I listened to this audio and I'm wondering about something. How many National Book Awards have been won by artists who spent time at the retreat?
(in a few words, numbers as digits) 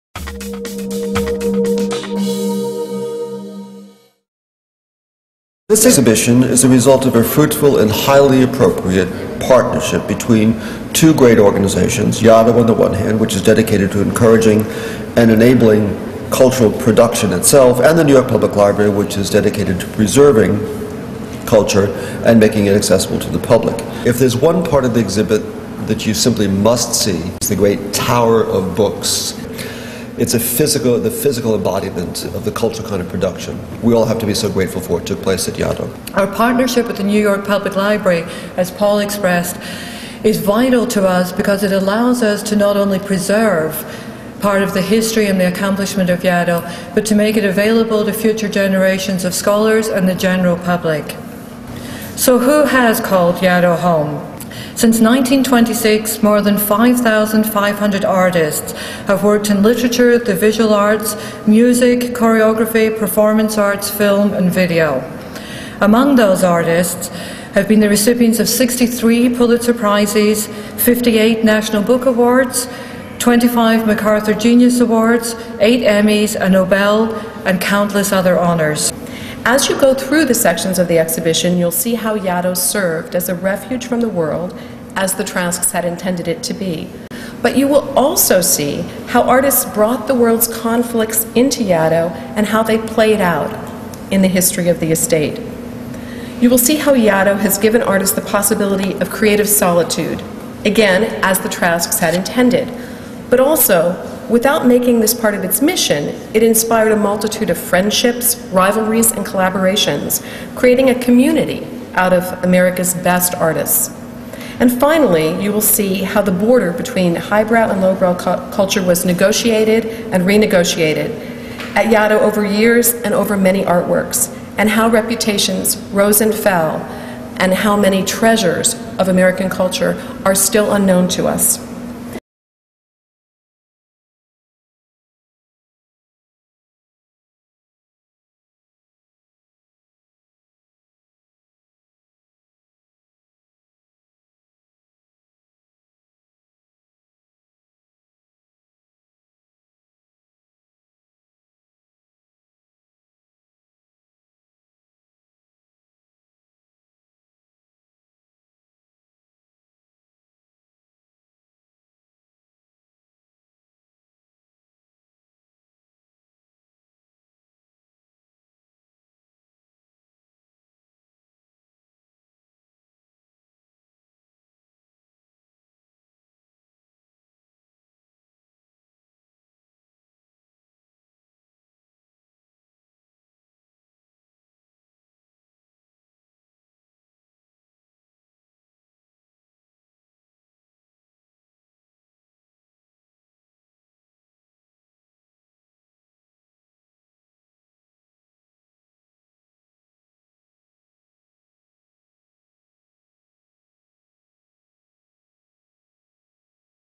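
58.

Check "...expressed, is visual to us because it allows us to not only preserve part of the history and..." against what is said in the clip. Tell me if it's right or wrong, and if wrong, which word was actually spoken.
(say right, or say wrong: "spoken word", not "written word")
wrong: "vital", not "visual".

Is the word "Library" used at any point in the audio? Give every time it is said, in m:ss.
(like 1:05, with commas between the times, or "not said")
0:18, 0:37.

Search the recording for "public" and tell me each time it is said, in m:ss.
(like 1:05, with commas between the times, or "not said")
0:18, 0:23, 0:37, 0:50.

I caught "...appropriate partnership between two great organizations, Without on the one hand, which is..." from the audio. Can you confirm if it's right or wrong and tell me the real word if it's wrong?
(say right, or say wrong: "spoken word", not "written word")
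wrong: "Yaddo", not "Without".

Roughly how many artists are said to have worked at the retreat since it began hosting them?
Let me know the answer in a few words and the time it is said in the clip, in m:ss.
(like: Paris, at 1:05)
5,500, at 0:56.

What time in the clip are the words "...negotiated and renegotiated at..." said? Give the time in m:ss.
1:59.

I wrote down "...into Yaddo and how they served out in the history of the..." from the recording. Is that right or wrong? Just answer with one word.
wrong.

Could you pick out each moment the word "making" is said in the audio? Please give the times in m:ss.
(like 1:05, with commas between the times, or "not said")
0:22, 1:44.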